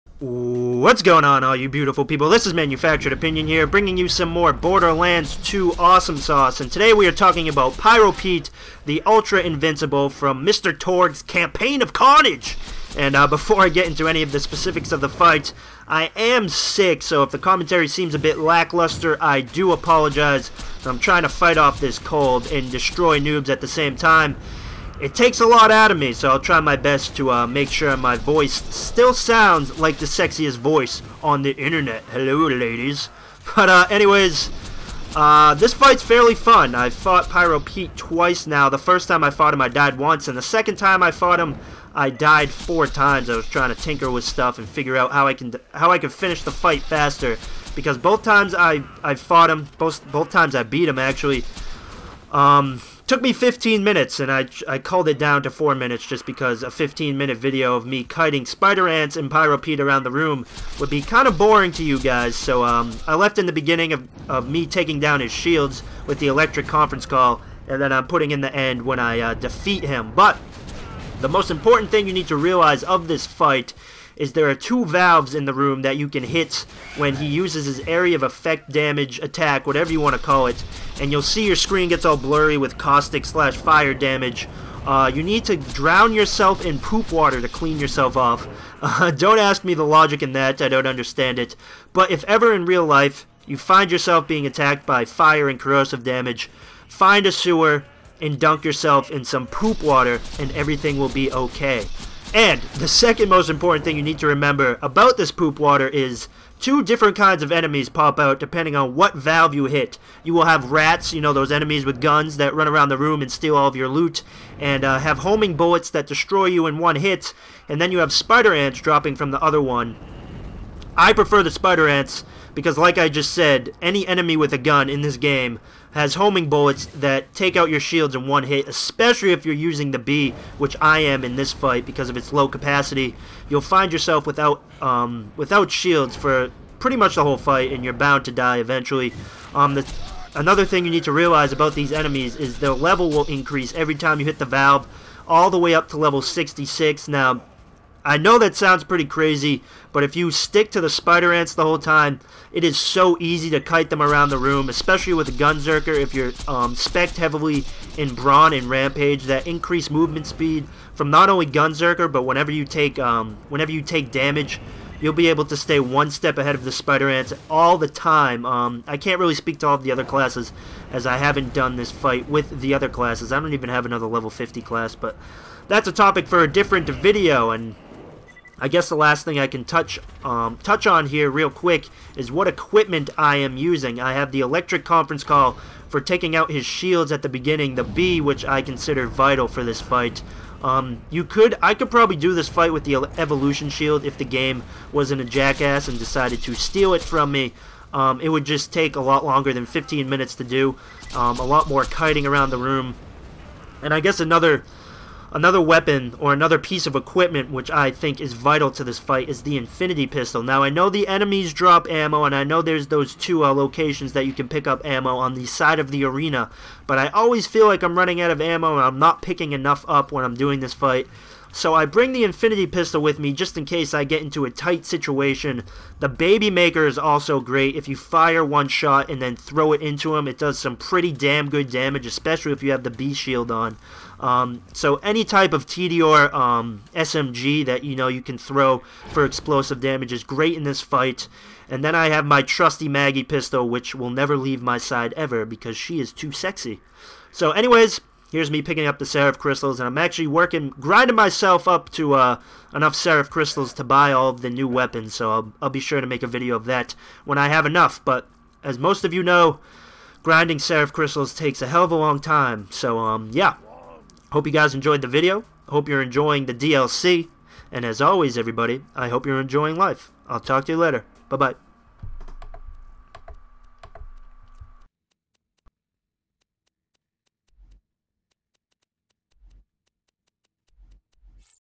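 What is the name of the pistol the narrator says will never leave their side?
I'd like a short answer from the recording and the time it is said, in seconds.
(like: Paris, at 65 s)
Maggie, at 242 s.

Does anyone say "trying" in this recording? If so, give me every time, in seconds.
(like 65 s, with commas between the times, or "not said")
20 s, 43 s.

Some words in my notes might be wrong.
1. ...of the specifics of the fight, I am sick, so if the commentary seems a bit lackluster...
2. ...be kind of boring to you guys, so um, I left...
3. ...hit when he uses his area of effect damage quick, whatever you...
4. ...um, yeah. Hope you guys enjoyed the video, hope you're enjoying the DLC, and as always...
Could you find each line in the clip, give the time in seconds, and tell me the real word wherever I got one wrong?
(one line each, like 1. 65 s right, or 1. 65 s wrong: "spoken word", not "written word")
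1. 14 s right
2. 60 s right
3. 76 s wrong: "attack", not "quick"
4. 262 s right.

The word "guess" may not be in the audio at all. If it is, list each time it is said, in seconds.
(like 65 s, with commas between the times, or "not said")
178 s, 204 s.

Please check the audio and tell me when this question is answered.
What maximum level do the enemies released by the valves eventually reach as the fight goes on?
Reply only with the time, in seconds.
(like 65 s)
145 s.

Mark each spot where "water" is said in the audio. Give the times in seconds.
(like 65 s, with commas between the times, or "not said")
87 s, 99 s, 105 s.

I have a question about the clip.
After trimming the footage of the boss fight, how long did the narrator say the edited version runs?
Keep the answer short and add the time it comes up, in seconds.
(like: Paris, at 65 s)
4 minutes, at 55 s.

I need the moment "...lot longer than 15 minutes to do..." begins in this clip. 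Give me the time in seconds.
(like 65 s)
199 s.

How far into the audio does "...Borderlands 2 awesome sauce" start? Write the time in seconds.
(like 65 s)
4 s.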